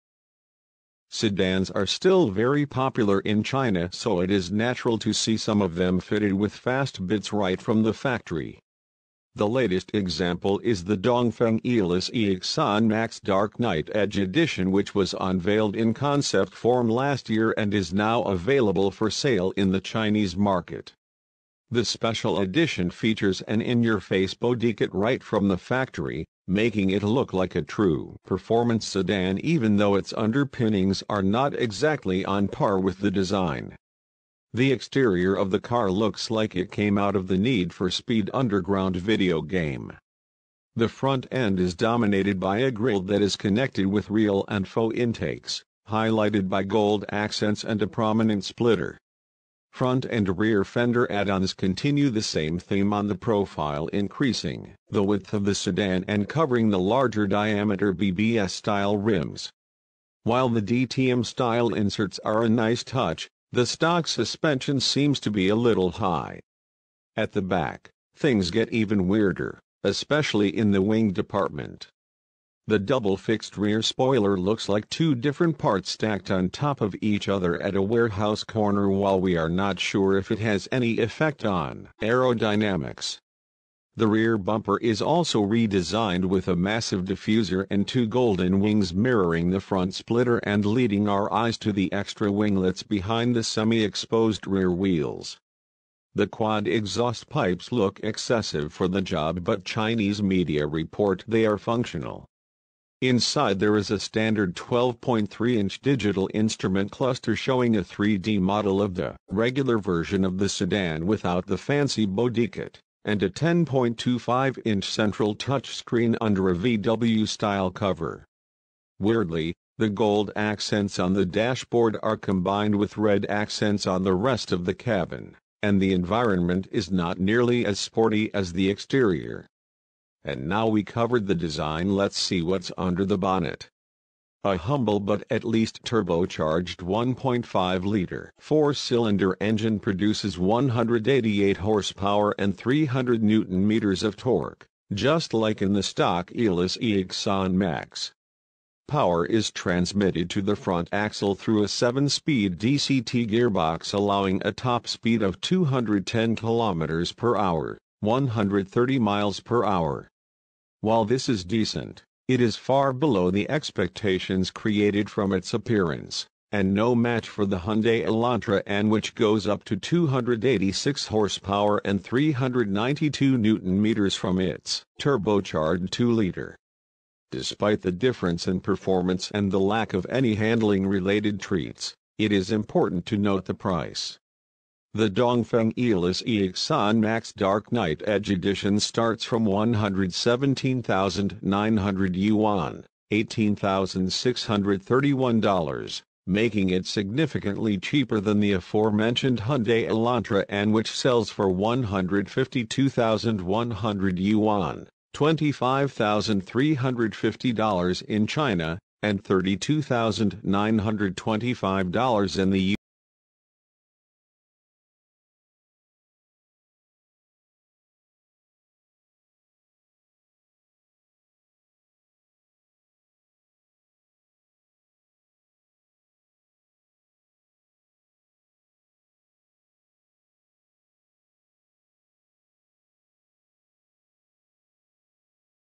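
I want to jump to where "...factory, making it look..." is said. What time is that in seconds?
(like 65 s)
25 s.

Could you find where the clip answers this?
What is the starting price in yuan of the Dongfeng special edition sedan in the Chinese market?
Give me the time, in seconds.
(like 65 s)
189 s.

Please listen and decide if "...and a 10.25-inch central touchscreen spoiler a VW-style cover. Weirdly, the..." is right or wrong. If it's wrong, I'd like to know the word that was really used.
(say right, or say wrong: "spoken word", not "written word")
wrong: "under", not "spoiler".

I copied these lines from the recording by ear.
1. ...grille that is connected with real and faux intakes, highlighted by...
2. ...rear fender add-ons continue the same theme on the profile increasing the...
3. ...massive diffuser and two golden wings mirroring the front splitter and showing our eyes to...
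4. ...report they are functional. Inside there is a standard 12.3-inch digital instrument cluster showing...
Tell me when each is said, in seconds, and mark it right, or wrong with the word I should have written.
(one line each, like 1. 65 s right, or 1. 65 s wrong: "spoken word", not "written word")
1. 42 s right
2. 50 s right
3. 86 s wrong: "leading", not "showing"
4. 100 s right.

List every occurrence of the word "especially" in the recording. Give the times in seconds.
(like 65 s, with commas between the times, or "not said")
69 s.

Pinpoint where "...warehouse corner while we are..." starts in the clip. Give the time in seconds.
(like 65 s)
77 s.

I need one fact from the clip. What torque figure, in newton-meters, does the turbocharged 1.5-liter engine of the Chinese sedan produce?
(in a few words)
300 newton-meters.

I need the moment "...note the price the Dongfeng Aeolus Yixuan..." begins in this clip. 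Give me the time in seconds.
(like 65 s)
183 s.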